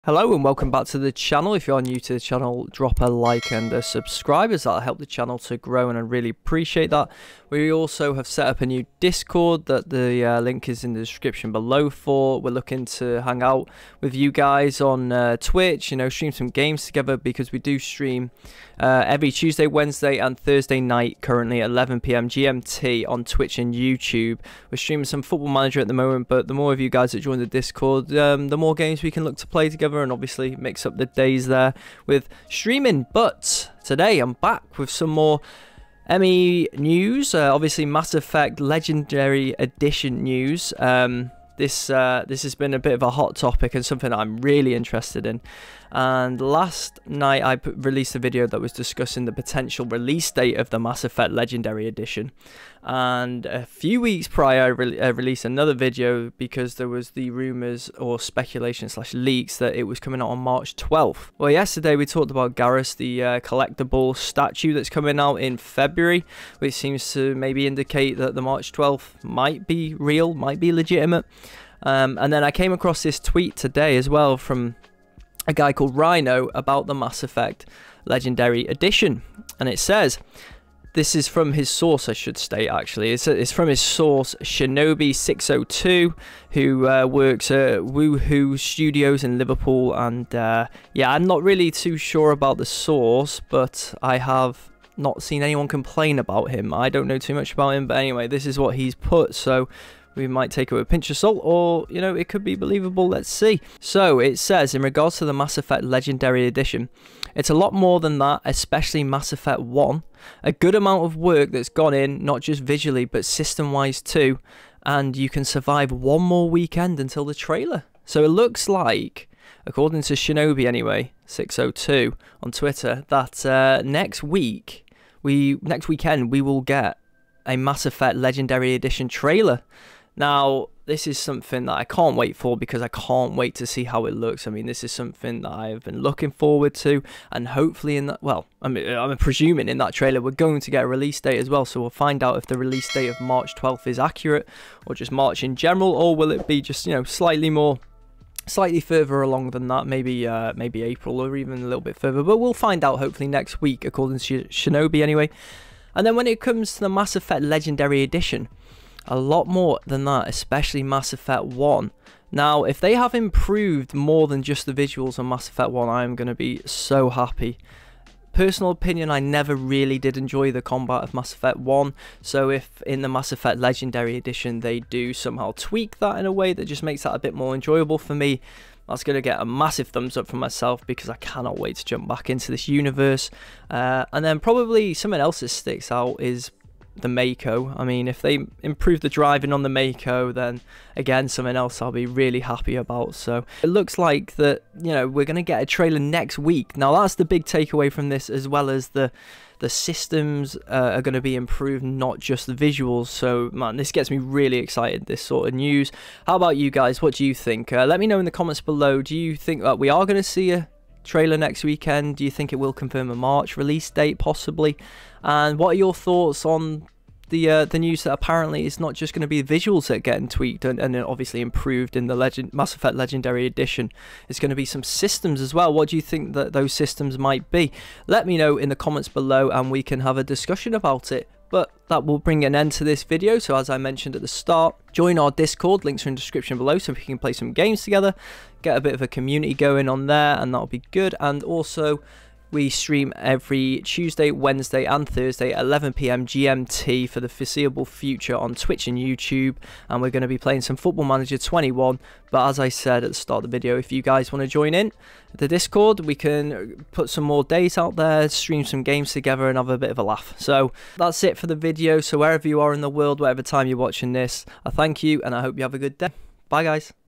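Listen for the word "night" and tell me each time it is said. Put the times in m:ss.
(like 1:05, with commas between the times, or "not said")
0:20, 0:47.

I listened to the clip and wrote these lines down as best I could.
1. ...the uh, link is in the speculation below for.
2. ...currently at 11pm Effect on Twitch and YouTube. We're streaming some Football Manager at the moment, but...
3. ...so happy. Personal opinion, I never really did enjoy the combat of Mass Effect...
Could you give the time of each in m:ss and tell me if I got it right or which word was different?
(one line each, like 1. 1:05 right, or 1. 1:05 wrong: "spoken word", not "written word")
1. 0:09 wrong: "description", not "speculation"
2. 0:21 wrong: "GMT", not "Effect"
3. 2:46 right.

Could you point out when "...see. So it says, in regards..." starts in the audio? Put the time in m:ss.
1:43.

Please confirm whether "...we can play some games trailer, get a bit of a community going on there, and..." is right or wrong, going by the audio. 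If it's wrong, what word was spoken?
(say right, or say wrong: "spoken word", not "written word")
wrong: "together", not "trailer".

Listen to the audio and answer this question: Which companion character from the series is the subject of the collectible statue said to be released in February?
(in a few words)
Garrus.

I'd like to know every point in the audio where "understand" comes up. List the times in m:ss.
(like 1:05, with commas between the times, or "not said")
not said.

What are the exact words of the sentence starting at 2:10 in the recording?
Now, this is something that I can't wait for because I can't wait to see how it looks.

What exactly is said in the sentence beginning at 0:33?
But today I'm back with some more ME news, uh, obviously Mass Effect Legendary Edition news.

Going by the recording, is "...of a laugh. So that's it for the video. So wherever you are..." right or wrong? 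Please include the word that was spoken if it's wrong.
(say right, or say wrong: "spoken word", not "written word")
right.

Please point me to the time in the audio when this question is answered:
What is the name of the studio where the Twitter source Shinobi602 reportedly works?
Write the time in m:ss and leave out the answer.
1:27.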